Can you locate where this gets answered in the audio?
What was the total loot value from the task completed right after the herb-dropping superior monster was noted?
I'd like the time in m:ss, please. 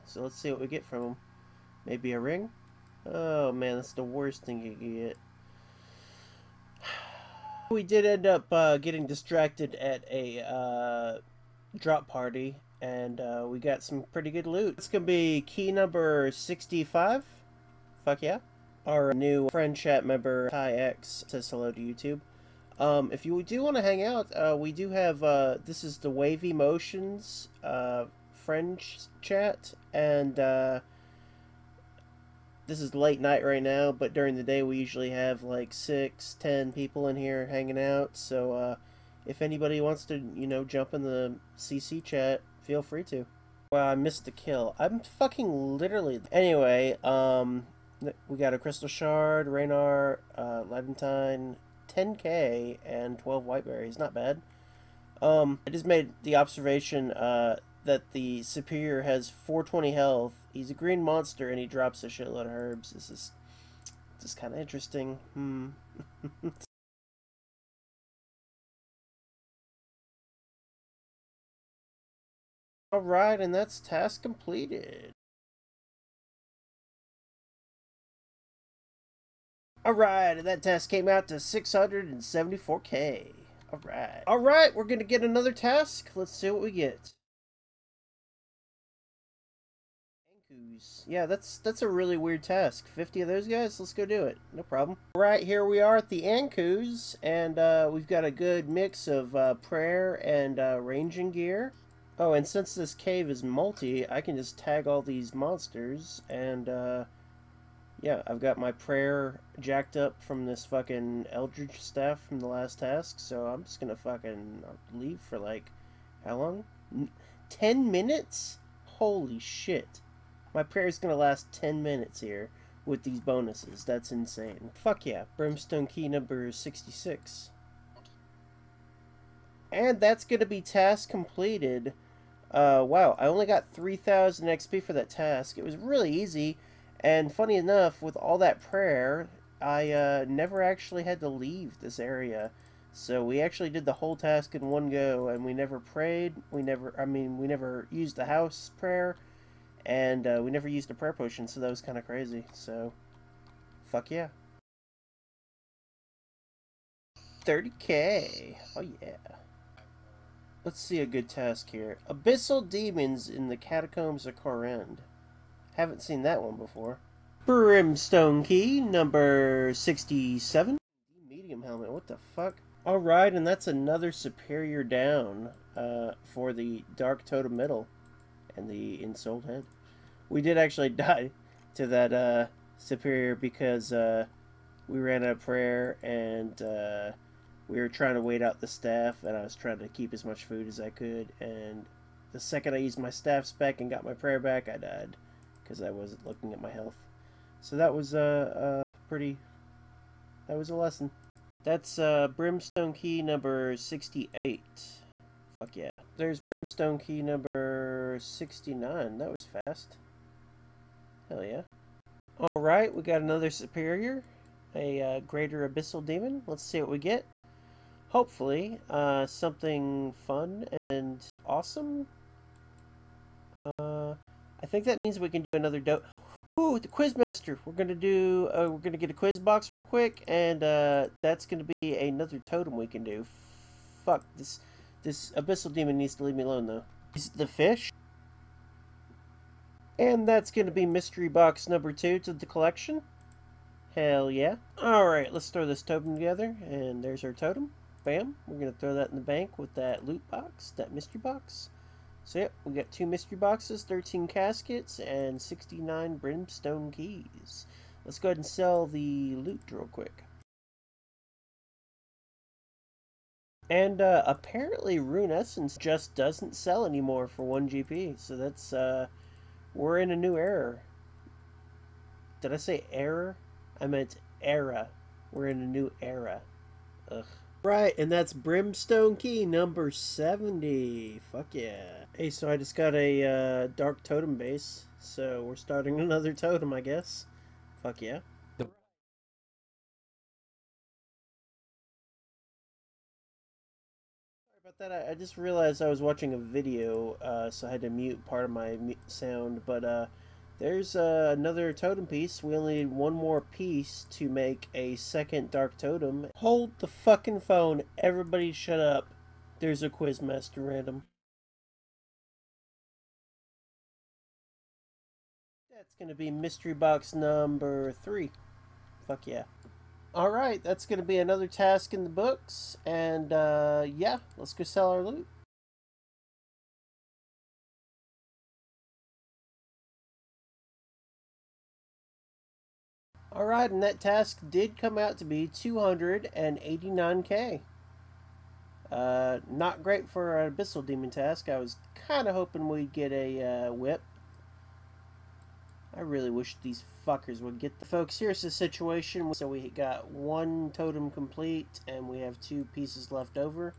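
1:21.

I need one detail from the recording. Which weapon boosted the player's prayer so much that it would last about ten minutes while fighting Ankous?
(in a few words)
Eldritch staff.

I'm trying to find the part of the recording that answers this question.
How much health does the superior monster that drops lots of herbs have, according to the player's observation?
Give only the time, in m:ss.
0:59.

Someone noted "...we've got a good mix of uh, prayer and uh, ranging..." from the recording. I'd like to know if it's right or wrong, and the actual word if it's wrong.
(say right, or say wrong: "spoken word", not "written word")
right.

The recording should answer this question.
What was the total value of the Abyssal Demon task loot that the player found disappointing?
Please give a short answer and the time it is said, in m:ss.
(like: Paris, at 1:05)
289k, at 5:35.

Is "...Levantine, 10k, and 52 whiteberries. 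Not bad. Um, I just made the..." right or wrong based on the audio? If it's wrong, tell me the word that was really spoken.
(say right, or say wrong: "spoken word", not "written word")
wrong: "12", not "52".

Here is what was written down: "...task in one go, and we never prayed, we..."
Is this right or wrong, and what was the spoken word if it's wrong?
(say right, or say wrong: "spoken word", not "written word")
right.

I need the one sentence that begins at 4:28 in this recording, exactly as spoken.
So that's, uh, we're in a new era.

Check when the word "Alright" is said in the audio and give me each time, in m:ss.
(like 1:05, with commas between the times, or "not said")
2:52, 3:32, 4:04.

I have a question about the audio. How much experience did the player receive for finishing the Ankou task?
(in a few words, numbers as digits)
3,000 XP.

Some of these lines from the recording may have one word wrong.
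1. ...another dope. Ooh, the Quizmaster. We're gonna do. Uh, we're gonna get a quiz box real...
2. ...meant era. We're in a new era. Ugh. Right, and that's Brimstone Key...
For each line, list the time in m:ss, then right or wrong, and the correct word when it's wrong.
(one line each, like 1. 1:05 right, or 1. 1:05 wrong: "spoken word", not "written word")
1. 3:45 right
2. 4:33 right.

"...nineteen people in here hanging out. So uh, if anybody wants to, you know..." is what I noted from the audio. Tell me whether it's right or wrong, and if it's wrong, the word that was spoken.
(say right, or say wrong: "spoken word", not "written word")
wrong: "ten", not "nineteen".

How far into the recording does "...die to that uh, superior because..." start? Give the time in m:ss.
3:00.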